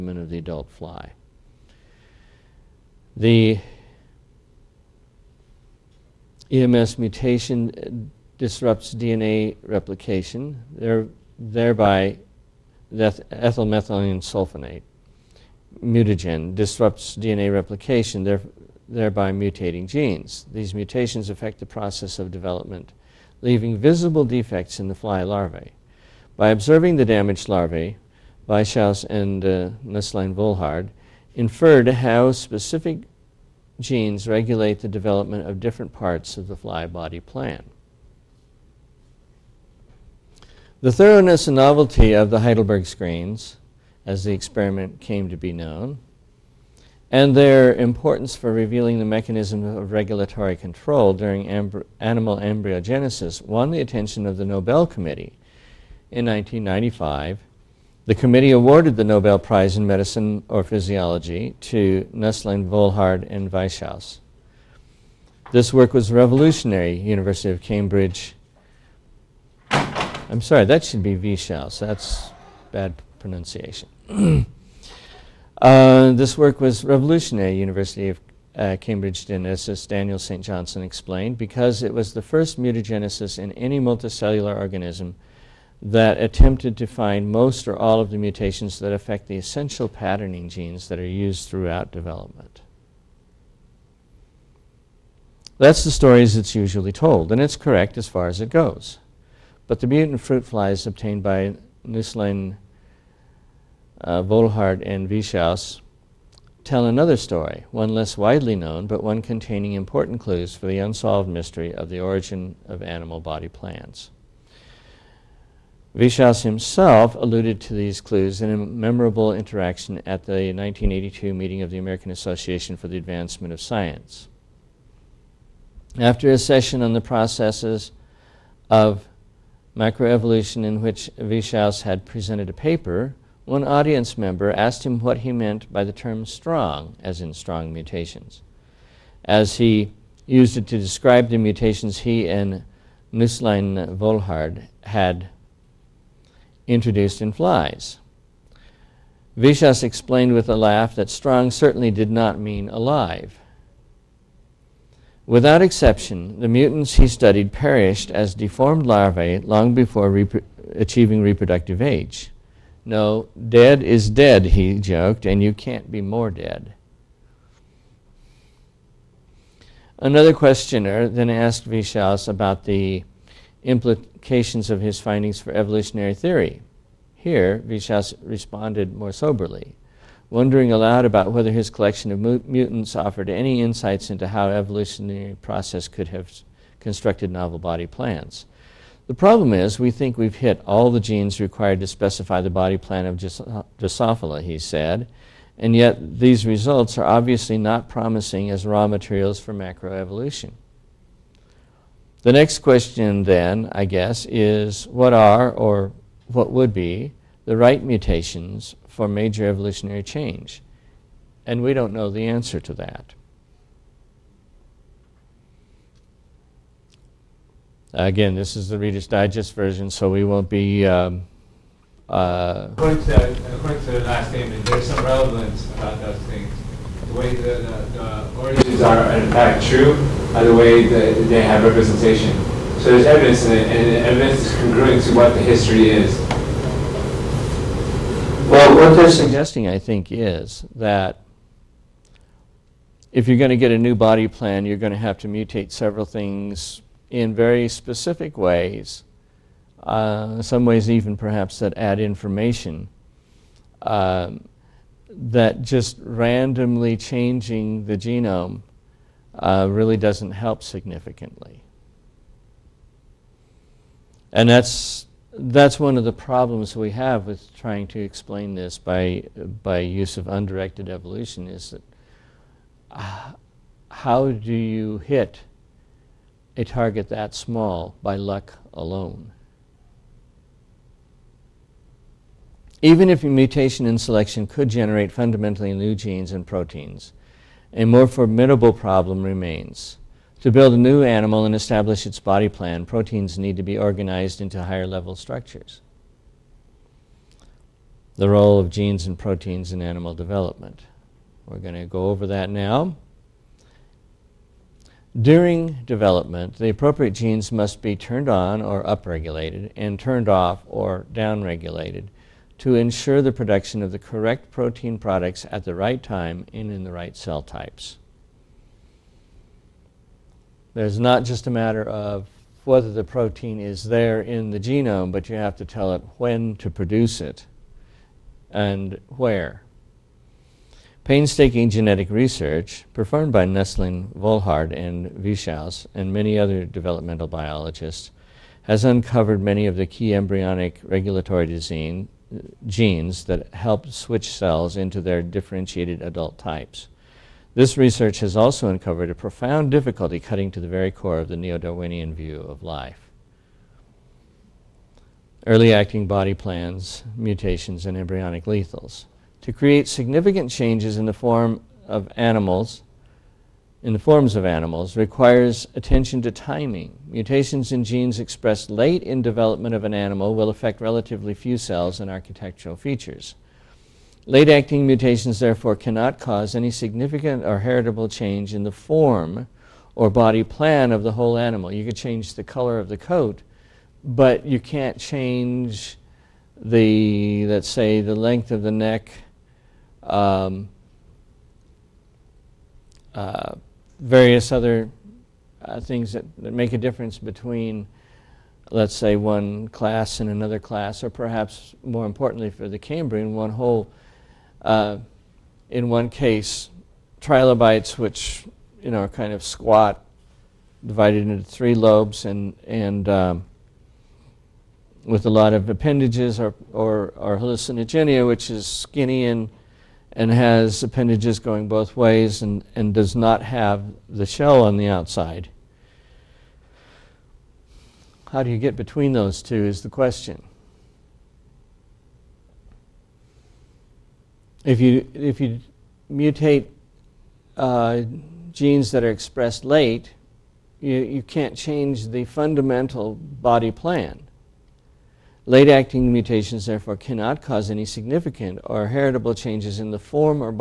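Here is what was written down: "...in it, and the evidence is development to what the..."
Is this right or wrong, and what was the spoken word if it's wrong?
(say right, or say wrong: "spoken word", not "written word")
wrong: "congruent", not "development".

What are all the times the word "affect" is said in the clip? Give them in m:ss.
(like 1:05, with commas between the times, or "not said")
0:21, 1:28, 6:10.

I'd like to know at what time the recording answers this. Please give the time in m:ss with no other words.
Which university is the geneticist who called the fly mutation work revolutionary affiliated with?
1:17.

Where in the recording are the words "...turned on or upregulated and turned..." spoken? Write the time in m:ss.
5:07.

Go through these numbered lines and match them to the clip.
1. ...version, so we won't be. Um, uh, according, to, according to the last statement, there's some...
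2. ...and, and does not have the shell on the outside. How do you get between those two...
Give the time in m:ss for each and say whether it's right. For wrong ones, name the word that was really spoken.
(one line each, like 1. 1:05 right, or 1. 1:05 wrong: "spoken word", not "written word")
1. 3:39 right
2. 7:02 right.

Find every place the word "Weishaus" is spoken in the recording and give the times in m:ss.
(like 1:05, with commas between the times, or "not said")
0:28, 1:03.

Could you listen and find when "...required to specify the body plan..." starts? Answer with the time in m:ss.
3:11.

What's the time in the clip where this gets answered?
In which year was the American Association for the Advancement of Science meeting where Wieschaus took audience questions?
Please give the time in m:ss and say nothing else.
2:00.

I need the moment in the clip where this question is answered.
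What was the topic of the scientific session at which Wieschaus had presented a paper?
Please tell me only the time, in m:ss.
2:09.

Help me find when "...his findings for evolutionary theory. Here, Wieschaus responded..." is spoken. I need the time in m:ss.
2:54.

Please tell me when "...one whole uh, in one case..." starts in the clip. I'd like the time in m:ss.
6:43.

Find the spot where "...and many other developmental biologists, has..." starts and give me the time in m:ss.
5:35.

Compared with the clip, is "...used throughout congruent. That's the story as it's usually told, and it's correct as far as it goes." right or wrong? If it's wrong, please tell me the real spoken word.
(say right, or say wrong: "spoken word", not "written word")
wrong: "development", not "congruent".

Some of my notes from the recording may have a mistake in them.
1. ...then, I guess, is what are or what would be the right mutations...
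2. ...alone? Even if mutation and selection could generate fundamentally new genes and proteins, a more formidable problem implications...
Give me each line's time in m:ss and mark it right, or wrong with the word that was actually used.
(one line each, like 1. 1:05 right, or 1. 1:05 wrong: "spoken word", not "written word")
1. 3:23 right
2. 4:38 wrong: "remains", not "implications".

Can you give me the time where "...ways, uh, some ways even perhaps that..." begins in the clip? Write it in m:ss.
4:08.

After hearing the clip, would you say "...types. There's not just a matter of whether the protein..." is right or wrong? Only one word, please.
right.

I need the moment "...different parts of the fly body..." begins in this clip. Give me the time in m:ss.
0:35.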